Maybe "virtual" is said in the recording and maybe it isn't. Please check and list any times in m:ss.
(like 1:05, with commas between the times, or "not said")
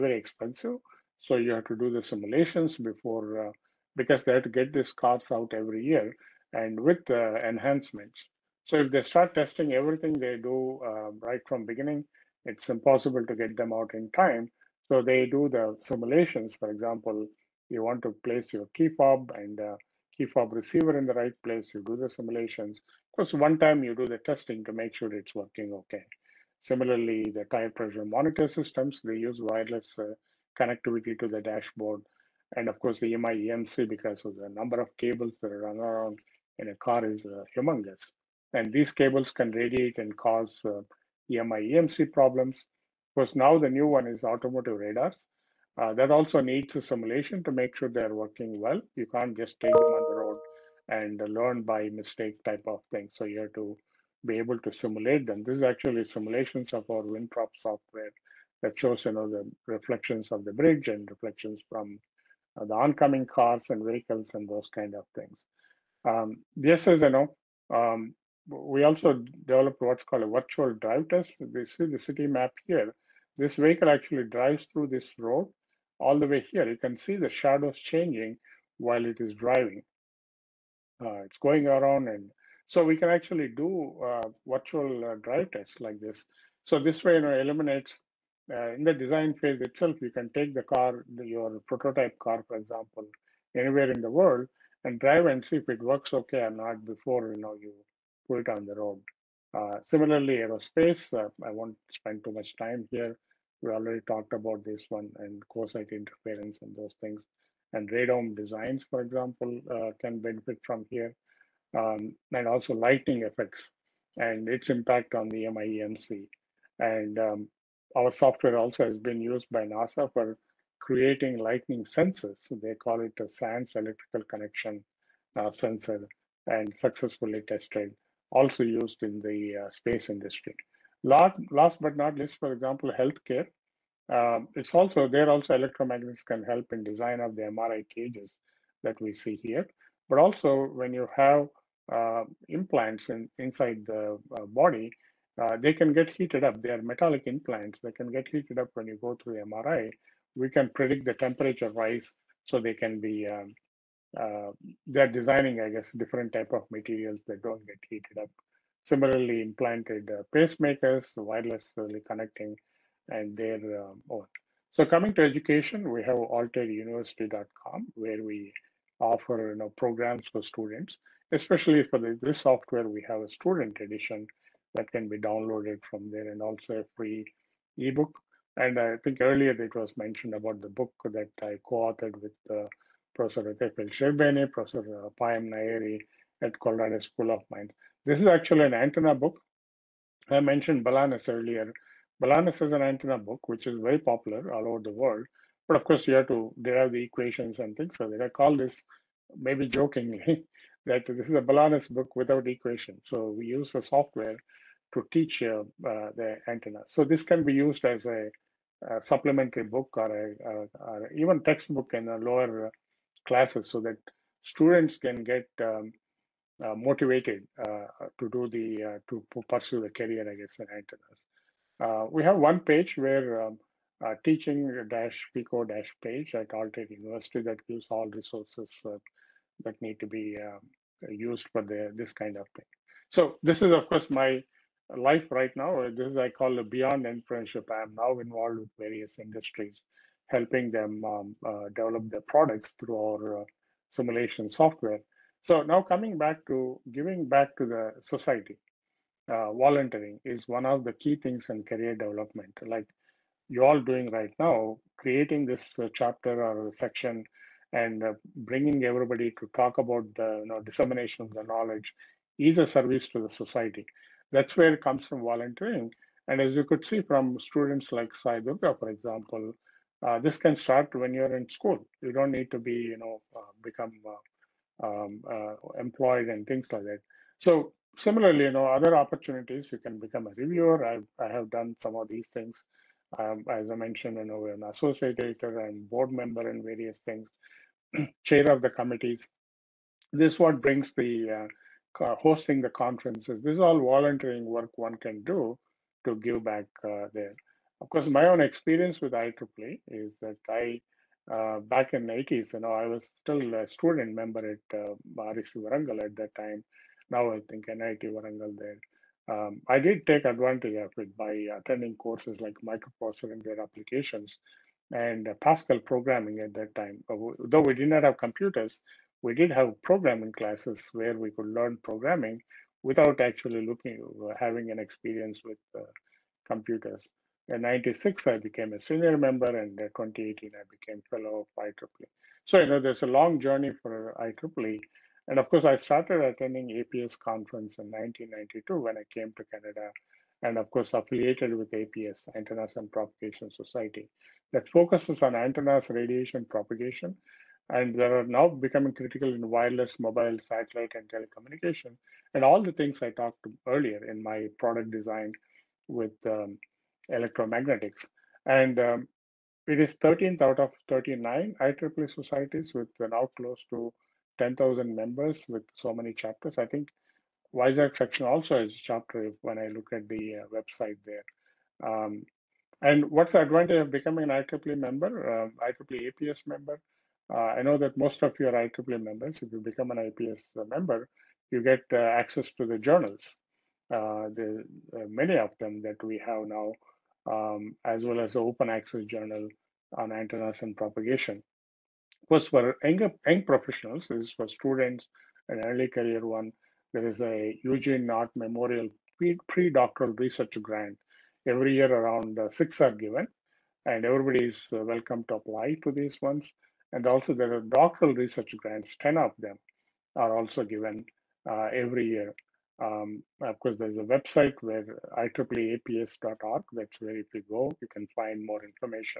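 1:10, 1:24.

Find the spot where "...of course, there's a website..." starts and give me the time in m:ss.
6:53.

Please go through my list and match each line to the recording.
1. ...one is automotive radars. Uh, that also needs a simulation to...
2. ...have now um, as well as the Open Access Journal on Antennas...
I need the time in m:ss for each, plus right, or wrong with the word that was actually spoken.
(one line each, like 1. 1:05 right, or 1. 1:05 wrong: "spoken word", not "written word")
1. 0:43 right
2. 6:26 right.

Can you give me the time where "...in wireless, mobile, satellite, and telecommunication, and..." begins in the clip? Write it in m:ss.
5:49.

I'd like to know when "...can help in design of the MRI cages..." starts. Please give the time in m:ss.
2:16.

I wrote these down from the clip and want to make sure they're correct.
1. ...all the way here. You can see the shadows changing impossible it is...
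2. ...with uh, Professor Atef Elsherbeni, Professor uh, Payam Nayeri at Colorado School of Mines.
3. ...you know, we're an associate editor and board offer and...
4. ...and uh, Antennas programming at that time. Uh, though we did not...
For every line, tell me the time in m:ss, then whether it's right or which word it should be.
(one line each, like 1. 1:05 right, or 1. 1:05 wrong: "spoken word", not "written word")
1. 1:15 wrong: "while", not "impossible"
2. 3:02 right
3. 4:44 wrong: "member", not "offer"
4. 5:14 wrong: "Pascal", not "Antennas".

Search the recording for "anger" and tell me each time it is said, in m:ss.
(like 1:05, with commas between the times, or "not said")
not said.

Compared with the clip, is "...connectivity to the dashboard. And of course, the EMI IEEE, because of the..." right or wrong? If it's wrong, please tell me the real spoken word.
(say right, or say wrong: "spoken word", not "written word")
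wrong: "EMC", not "IEEE".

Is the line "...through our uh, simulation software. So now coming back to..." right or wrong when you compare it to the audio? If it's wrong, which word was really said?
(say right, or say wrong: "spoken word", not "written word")
right.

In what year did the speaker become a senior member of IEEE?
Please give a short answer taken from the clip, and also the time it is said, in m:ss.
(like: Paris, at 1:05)
1996, at 5:27.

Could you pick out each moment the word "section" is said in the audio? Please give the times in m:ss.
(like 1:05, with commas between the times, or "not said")
4:16, 6:07.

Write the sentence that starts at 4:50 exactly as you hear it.
This what brings the uh, hosting the conferences.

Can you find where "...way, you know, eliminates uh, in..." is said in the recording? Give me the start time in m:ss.
1:27.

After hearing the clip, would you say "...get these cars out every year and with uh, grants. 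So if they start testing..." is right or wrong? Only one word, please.
wrong.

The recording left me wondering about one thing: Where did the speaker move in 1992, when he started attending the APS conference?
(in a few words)
Canada.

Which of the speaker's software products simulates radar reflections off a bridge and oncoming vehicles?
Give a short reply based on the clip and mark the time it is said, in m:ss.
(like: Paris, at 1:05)
WinProp, at 0:57.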